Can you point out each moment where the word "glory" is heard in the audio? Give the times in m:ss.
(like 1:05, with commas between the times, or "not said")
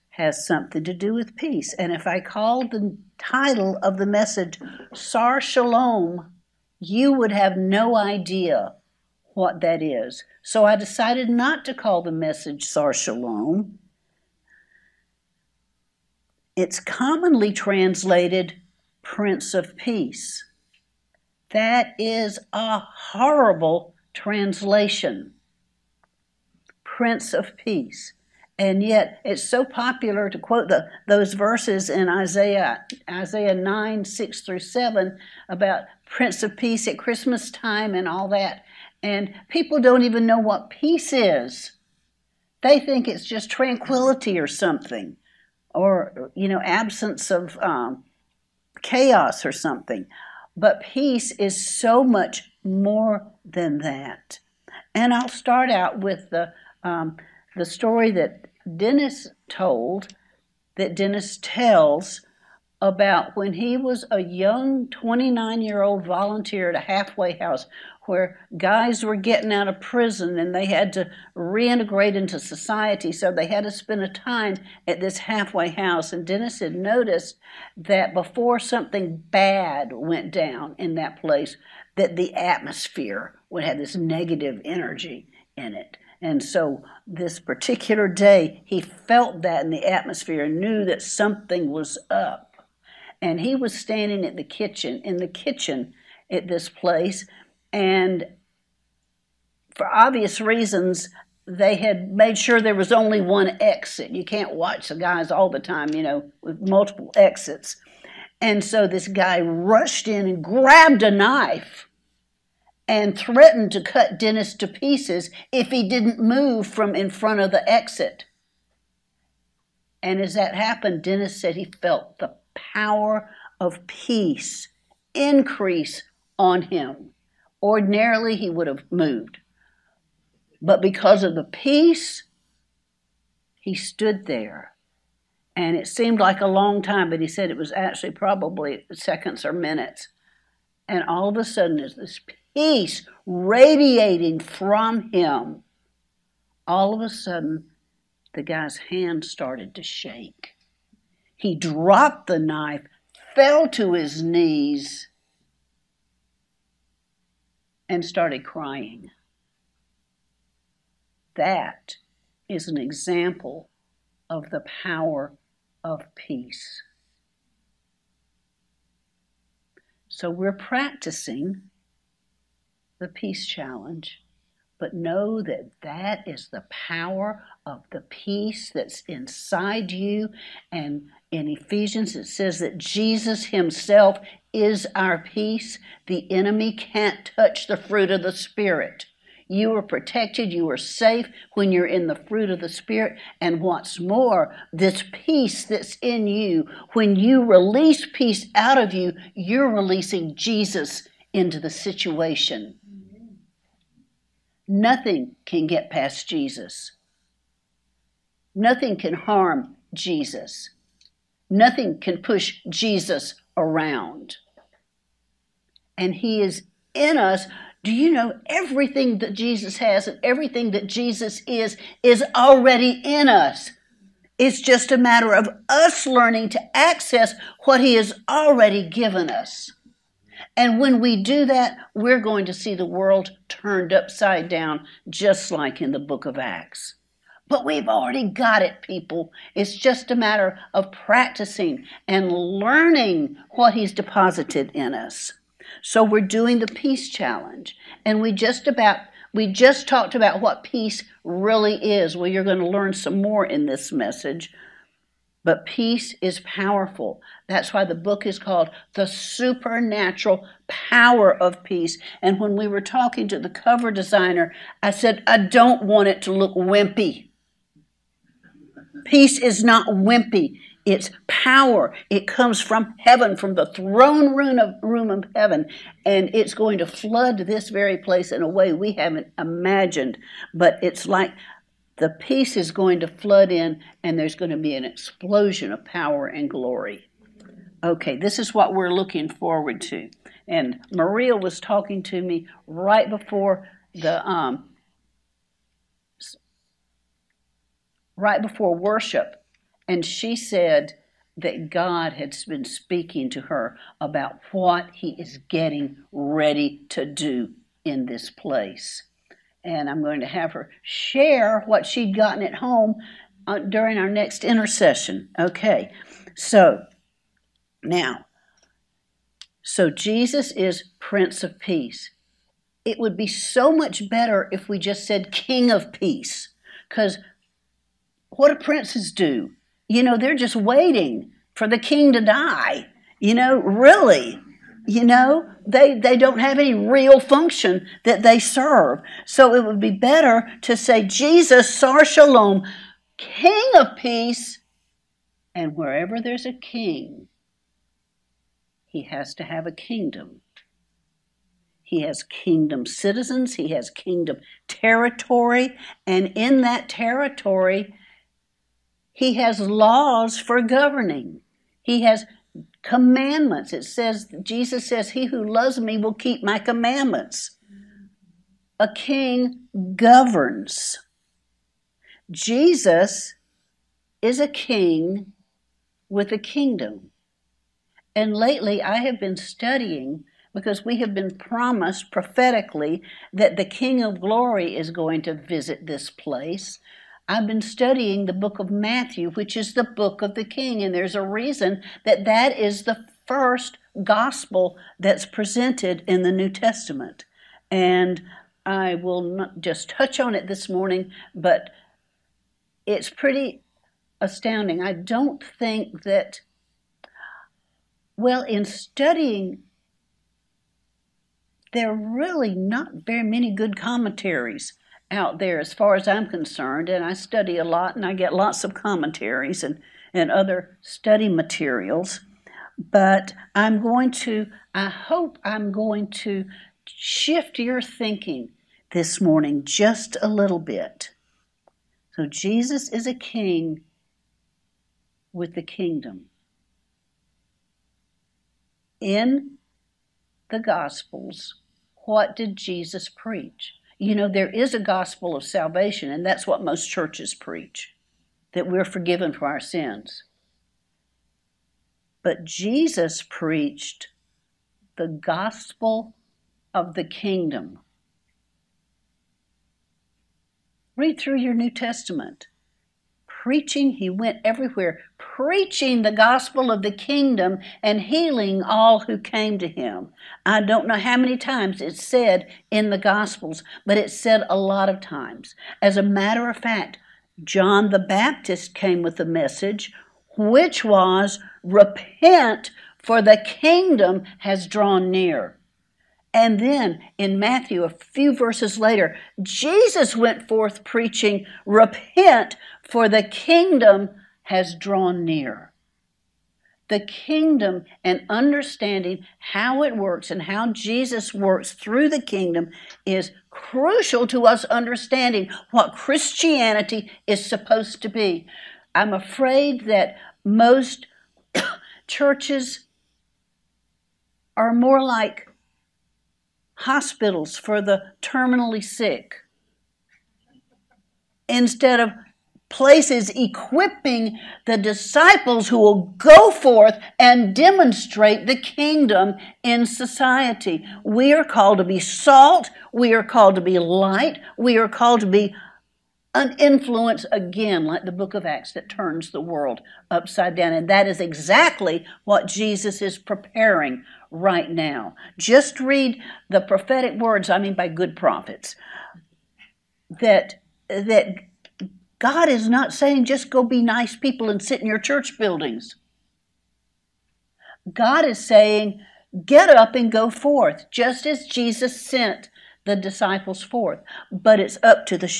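4:46, 6:24.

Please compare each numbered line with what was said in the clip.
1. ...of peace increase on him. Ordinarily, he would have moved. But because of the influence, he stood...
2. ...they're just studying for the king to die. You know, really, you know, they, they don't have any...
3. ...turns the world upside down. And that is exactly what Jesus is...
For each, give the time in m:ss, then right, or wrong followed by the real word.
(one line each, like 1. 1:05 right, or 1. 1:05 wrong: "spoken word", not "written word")
1. 2:03 wrong: "peace", not "influence"
2. 5:30 wrong: "waiting", not "studying"
3. 8:58 right.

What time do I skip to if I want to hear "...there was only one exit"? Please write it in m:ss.
1:42.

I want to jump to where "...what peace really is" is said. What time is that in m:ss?
4:10.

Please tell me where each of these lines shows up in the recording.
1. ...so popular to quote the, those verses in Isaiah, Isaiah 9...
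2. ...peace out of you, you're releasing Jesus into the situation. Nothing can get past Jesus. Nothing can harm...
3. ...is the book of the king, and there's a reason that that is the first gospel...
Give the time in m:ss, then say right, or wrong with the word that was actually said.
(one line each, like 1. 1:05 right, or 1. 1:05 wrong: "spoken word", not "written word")
1. 0:29 right
2. 3:18 right
3. 6:29 right.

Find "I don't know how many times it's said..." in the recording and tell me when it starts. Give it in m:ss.
7:50.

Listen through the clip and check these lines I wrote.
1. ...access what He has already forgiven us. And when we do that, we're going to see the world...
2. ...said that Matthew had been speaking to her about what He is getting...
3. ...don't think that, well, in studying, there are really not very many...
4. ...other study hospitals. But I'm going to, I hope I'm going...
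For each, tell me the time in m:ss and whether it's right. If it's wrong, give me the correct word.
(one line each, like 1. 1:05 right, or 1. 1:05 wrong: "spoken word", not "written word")
1. 3:46 wrong: "given", not "forgiven"
2. 5:00 wrong: "God", not "Matthew"
3. 6:44 right
4. 7:00 wrong: "materials", not "hospitals".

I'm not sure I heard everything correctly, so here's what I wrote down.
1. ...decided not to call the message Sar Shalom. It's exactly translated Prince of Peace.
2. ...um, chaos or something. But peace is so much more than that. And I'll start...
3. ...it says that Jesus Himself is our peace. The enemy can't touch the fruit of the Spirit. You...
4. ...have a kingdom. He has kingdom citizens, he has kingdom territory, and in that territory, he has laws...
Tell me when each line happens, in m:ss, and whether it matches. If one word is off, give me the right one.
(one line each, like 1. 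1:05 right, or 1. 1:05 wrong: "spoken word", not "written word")
1. 0:10 wrong: "commonly", not "exactly"
2. 0:47 right
3. 3:02 right
4. 5:49 right.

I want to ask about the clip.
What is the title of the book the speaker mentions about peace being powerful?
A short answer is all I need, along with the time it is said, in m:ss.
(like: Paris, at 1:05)
The Supernatural Power of Peace, at 4:18.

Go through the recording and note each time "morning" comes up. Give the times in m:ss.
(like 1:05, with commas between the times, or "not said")
6:40, 7:09.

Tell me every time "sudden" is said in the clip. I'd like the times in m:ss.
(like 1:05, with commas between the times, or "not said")
2:21, 2:27.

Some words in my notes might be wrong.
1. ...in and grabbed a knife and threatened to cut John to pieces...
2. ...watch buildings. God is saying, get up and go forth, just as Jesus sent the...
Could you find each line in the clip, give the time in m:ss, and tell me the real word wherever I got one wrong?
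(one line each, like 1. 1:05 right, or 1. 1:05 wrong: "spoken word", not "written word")
1. 1:50 wrong: "Dennis", not "John"
2. 9:14 wrong: "church", not "watch".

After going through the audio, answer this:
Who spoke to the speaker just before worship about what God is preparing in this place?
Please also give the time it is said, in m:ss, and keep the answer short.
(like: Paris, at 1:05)
Maria, at 4:50.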